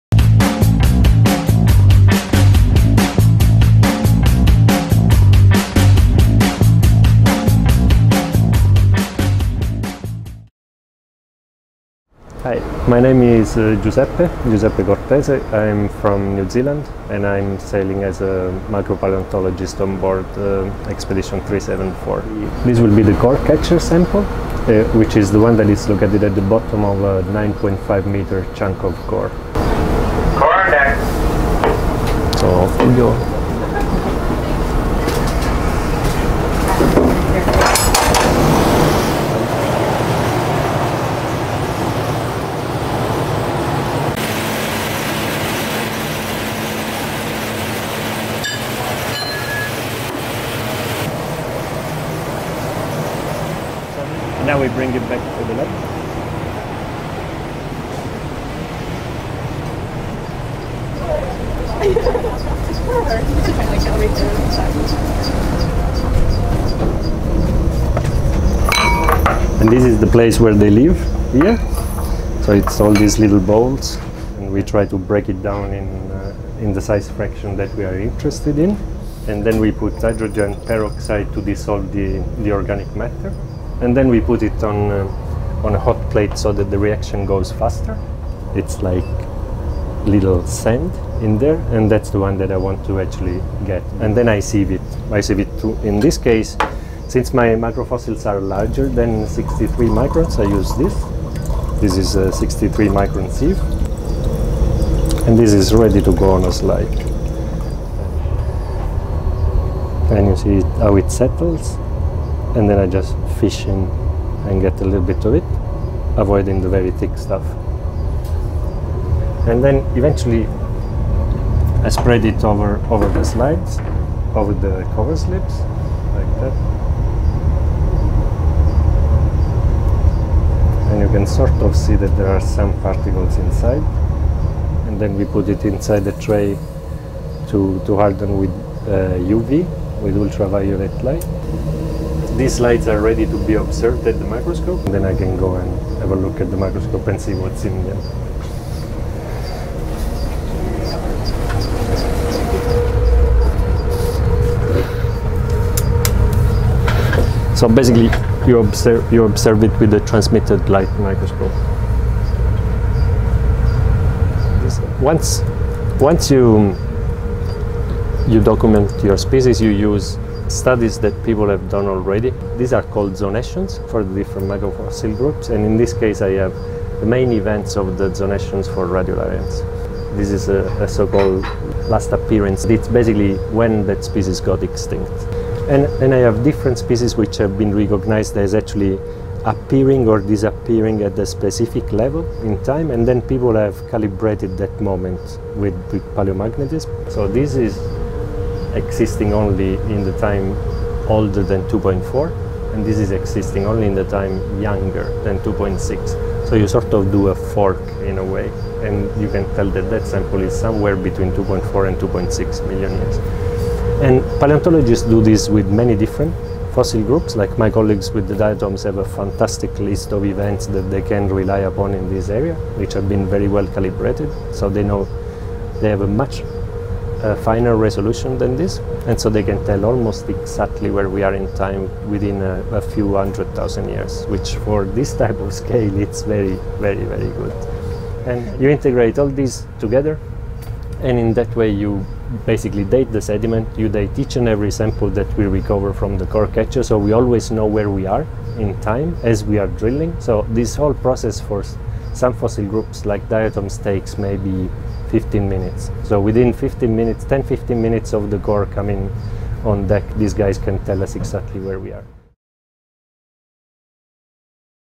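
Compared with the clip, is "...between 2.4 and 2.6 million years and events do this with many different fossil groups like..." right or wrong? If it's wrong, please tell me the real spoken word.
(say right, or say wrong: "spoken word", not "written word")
wrong: "paleontologists", not "events".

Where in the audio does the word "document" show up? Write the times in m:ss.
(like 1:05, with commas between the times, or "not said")
2:48.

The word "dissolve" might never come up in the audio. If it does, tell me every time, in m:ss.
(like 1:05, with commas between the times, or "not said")
1:21.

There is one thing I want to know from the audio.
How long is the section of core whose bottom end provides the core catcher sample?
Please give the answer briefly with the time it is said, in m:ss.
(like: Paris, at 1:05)
9.5 meters, at 0:27.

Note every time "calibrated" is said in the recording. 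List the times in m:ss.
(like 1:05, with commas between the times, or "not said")
3:13, 3:43.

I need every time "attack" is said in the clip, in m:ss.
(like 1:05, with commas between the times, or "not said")
not said.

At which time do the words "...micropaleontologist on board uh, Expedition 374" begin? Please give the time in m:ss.
0:18.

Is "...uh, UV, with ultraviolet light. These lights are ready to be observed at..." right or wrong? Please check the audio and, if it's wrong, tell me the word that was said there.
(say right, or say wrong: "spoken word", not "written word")
right.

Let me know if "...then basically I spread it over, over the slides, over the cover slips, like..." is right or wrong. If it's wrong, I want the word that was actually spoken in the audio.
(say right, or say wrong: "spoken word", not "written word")
wrong: "eventually", not "basically".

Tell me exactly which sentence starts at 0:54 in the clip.
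now we bring it back to the left.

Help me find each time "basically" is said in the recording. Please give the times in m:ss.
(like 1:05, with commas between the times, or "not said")
2:37, 3:02, 4:02.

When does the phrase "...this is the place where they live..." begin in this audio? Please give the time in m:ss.
1:09.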